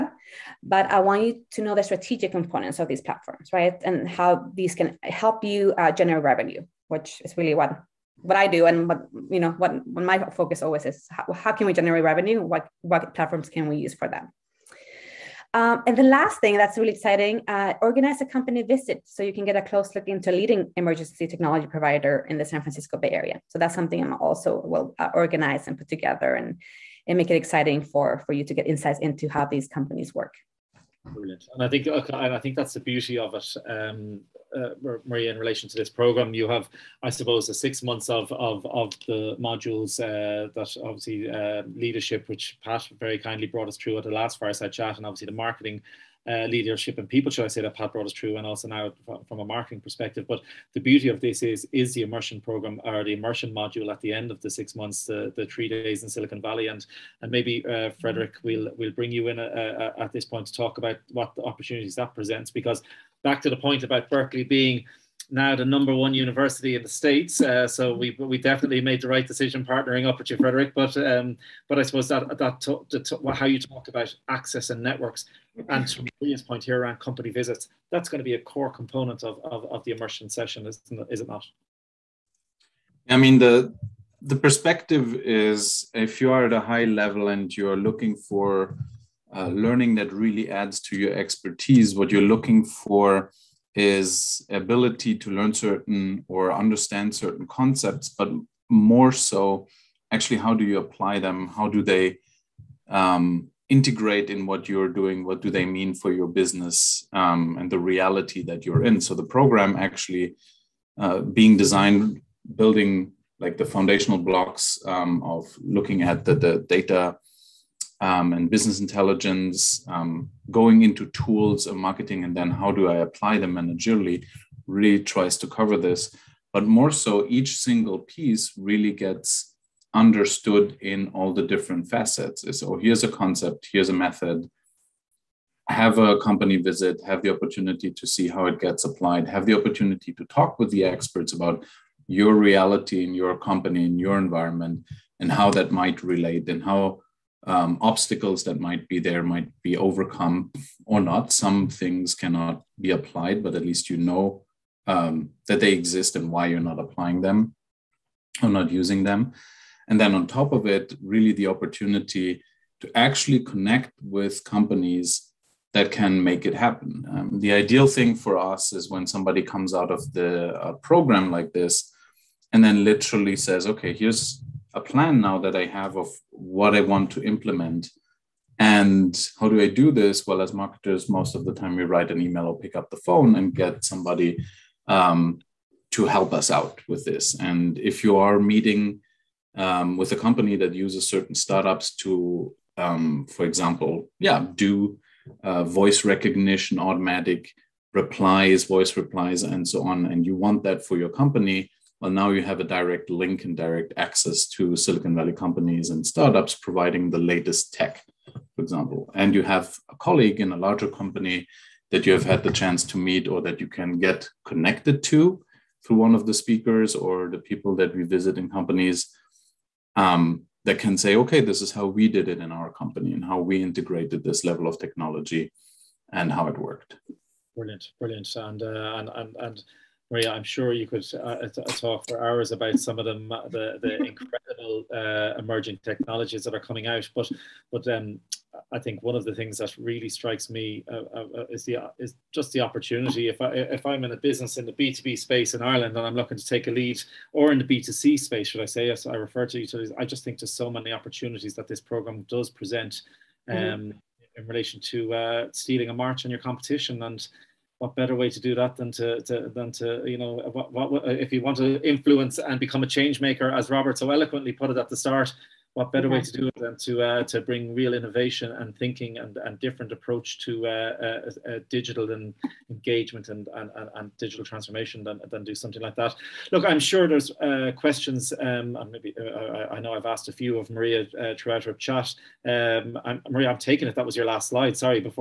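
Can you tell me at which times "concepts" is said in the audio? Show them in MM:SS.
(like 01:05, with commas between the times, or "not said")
01:37, 02:13.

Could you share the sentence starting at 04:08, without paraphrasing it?
As I refer to utilities, I just think there's so many opportunities that this program does present mm-hmm.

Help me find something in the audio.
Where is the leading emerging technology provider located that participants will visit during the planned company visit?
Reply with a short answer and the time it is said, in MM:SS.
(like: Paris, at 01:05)
San Francisco Bay Area, at 00:22.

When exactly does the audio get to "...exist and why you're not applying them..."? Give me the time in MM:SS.
02:35.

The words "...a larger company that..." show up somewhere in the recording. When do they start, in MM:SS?
03:30.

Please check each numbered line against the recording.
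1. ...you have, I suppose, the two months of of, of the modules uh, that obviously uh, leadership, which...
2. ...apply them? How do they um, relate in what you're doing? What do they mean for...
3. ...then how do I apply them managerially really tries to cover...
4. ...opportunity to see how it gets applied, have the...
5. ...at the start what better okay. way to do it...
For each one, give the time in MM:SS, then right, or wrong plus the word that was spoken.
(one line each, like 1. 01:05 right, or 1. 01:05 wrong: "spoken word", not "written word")
1. 00:36 wrong: "six", not "two"
2. 01:40 wrong: "integrate", not "relate"
3. 02:02 right
4. 02:17 right
5. 04:24 right.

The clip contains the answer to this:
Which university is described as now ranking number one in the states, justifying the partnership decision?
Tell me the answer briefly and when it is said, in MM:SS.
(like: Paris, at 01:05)
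Berkeley, at 01:04.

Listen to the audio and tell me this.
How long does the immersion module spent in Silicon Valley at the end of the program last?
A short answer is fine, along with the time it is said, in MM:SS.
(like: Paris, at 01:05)
3 days, at 00:55.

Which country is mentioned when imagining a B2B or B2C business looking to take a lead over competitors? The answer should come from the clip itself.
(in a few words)
Ireland.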